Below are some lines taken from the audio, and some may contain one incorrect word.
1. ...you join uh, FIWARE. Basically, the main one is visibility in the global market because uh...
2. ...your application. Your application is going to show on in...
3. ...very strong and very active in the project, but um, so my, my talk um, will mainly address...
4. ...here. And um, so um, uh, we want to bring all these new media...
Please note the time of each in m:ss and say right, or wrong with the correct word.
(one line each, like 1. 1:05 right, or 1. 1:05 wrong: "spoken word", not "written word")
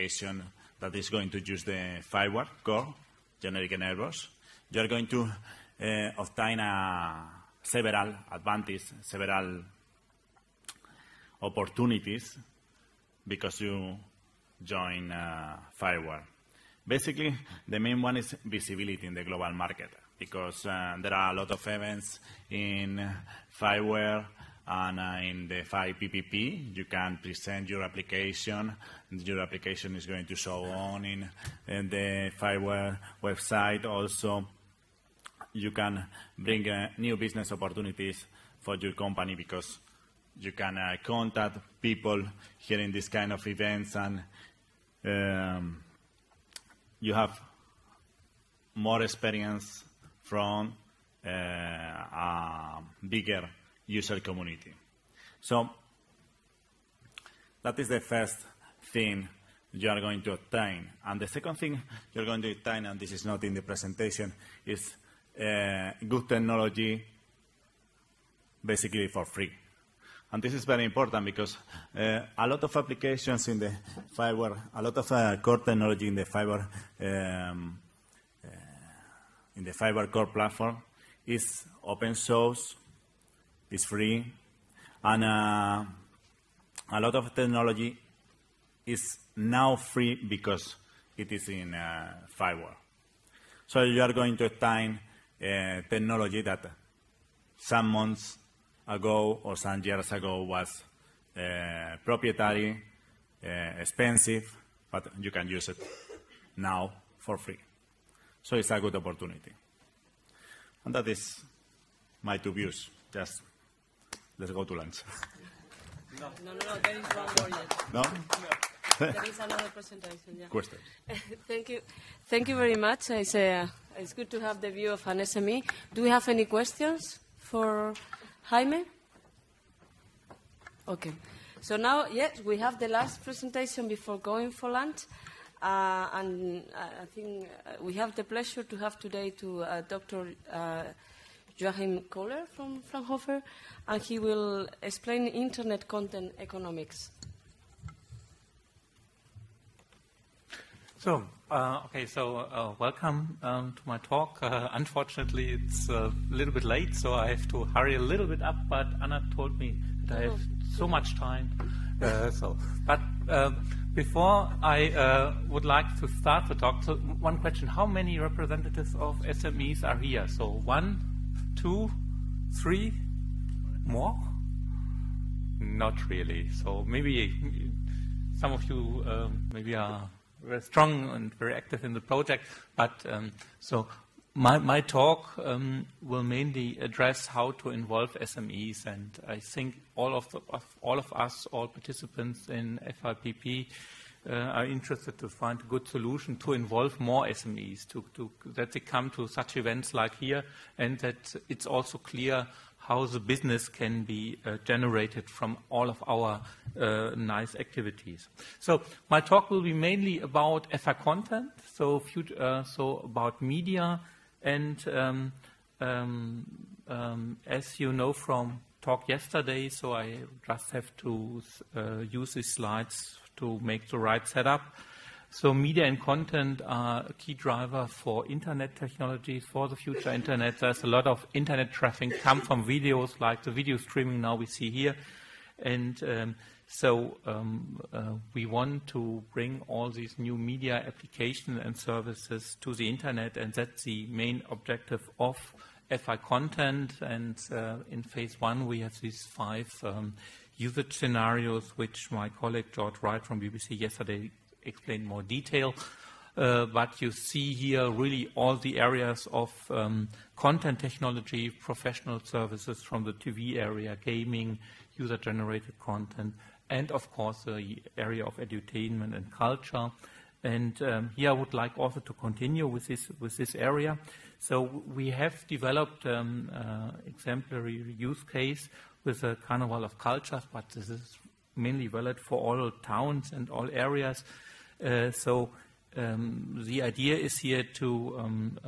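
1. 0:13 right
2. 0:27 right
3. 3:00 right
4. 3:54 right.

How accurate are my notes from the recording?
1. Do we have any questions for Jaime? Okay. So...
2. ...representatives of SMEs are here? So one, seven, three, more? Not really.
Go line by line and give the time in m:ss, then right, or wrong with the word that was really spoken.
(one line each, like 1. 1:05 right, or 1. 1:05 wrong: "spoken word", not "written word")
1. 2:05 right
2. 2:48 wrong: "two", not "seven".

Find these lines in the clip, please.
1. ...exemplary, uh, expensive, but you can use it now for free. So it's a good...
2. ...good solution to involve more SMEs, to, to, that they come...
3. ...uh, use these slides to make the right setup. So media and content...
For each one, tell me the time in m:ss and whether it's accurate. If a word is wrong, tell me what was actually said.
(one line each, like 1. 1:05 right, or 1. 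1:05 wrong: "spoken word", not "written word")
1. 1:42 wrong: "proprietary", not "exemplary"
2. 3:15 right
3. 3:41 right.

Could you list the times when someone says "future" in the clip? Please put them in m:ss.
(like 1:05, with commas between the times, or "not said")
3:31, 3:49.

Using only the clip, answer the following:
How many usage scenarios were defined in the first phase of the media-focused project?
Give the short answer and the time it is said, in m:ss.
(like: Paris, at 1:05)
5, at 4:09.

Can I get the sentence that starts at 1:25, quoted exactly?
And uh, a lot of technology is now free because it is in uh, FIWARE.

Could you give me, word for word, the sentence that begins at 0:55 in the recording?
So that is the first thing you are going to obtain.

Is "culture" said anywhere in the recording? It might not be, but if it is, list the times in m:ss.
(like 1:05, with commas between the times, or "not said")
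4:29, 4:39.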